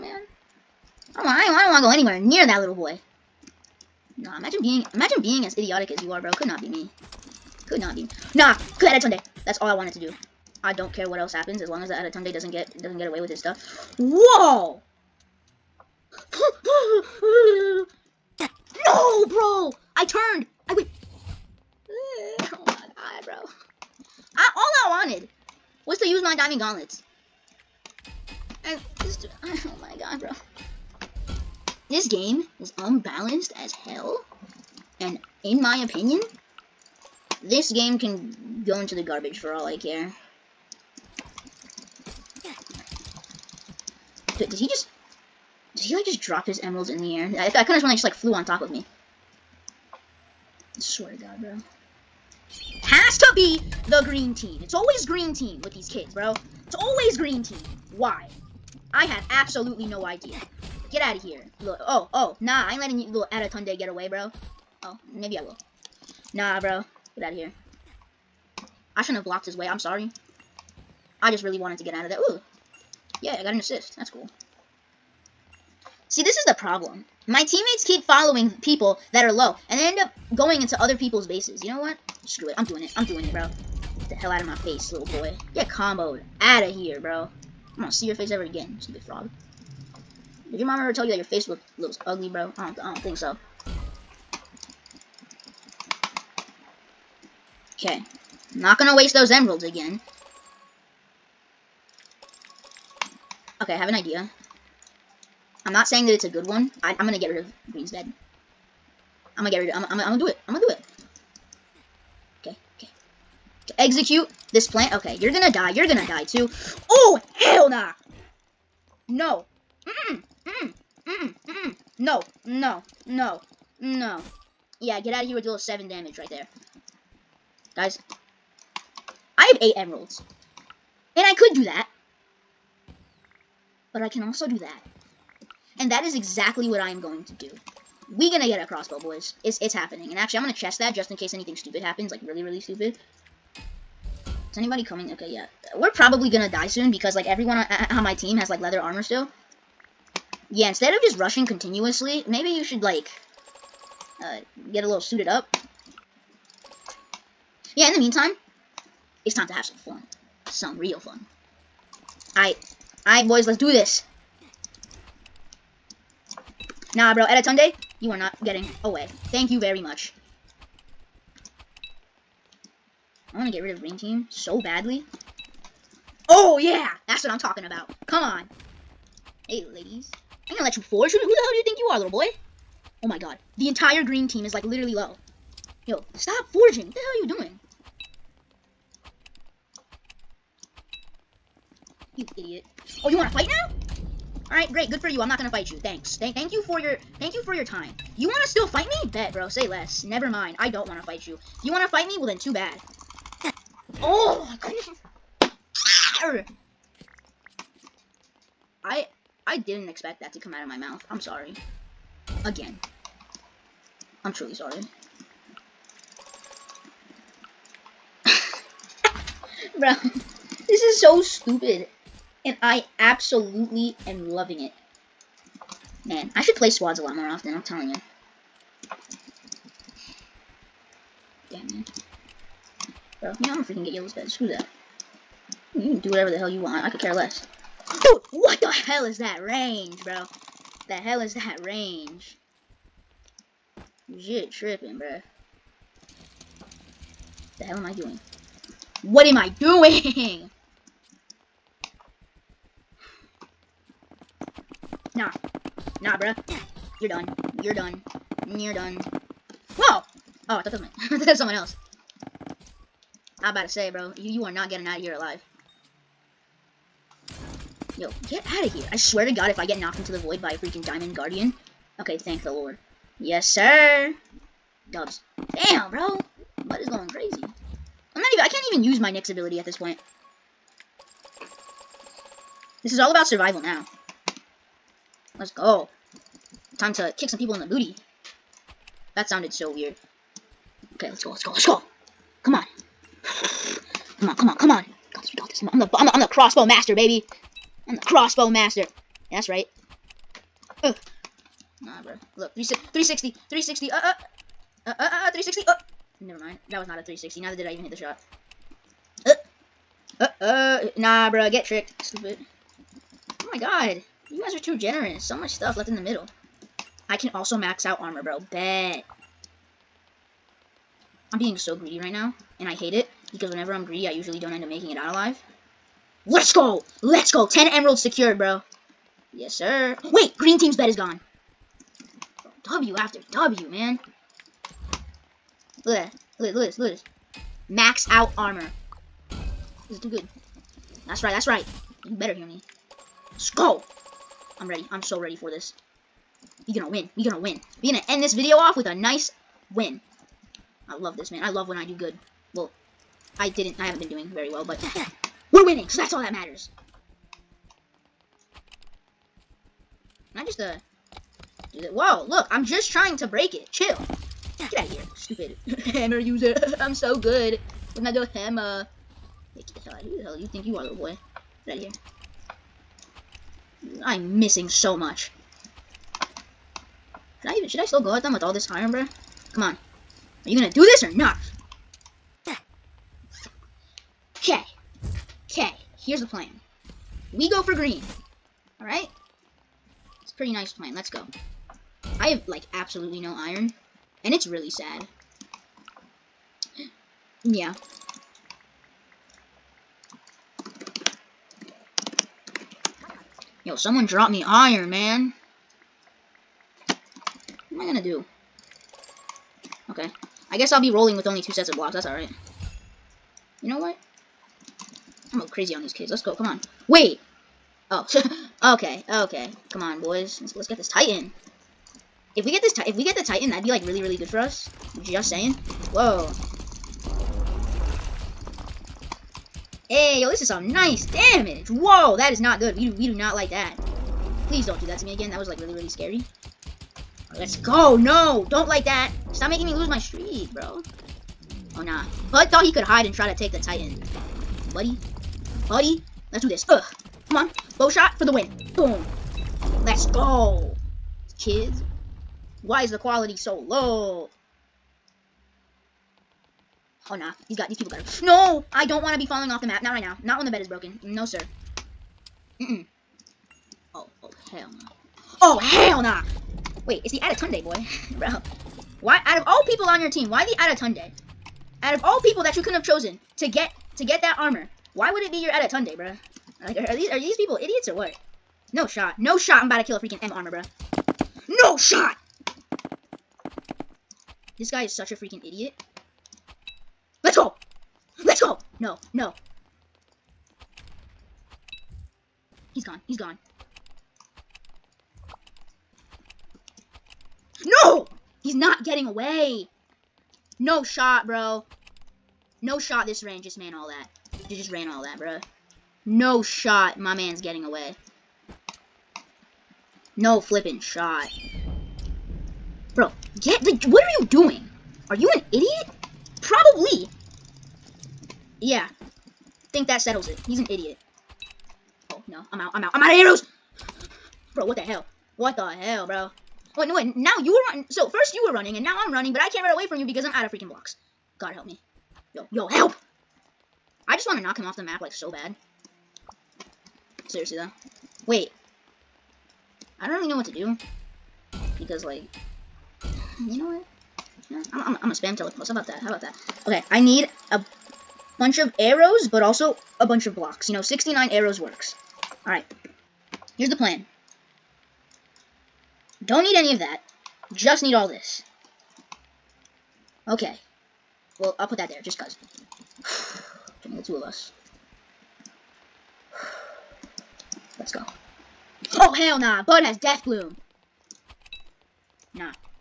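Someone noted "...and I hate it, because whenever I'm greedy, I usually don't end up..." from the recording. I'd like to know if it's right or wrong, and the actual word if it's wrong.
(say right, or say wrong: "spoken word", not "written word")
right.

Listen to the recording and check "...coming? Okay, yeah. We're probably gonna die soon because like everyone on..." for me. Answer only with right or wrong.
right.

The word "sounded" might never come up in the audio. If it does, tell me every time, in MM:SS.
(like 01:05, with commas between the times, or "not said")
04:49.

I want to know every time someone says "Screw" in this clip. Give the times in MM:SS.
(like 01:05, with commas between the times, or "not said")
01:22, 03:54.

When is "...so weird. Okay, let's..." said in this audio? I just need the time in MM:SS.
04:49.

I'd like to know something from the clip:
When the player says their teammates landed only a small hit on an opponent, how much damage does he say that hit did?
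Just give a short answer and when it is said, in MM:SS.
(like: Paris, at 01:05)
7, at 02:05.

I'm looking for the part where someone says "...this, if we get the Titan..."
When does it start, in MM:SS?
07:02.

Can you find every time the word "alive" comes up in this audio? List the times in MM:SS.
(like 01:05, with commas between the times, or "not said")
04:25, 05:25.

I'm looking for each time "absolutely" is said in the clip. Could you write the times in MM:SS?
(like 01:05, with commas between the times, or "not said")
00:59, 03:42, 06:32.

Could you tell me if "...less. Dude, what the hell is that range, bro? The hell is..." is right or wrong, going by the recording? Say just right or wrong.
right.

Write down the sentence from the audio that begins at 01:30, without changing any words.
Did your mom ever tell you that your face looked looks ugly, bro?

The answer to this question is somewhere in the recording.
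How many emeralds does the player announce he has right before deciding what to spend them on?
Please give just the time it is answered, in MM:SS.
02:09.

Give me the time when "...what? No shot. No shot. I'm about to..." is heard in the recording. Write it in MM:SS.
07:57.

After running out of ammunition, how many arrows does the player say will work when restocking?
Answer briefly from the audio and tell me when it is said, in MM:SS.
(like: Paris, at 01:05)
69, at 09:10.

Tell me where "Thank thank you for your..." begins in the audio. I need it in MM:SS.
03:16.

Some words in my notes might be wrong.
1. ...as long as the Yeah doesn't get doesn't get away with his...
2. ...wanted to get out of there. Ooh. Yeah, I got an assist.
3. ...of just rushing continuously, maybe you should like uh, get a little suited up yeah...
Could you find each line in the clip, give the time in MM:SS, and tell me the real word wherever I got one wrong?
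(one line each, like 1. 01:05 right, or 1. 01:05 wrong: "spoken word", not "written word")
1. 00:11 wrong: "Adetunde", not "Yeah"
2. 01:11 right
3. 02:30 right.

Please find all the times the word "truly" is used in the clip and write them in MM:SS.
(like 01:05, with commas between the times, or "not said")
03:34.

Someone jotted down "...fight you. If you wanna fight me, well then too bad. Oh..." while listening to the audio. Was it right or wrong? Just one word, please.
right.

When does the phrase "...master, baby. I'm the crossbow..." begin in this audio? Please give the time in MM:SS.
04:56.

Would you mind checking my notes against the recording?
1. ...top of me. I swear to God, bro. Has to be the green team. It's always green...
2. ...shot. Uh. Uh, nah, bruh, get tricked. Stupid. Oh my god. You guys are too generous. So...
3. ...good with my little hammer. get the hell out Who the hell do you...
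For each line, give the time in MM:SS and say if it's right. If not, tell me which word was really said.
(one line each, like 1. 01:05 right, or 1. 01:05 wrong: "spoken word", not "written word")
1. 00:48 right
2. 05:07 right
3. 06:07 right.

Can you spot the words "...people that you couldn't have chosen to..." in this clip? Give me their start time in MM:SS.
07:52.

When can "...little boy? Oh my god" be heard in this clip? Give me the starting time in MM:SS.
03:01.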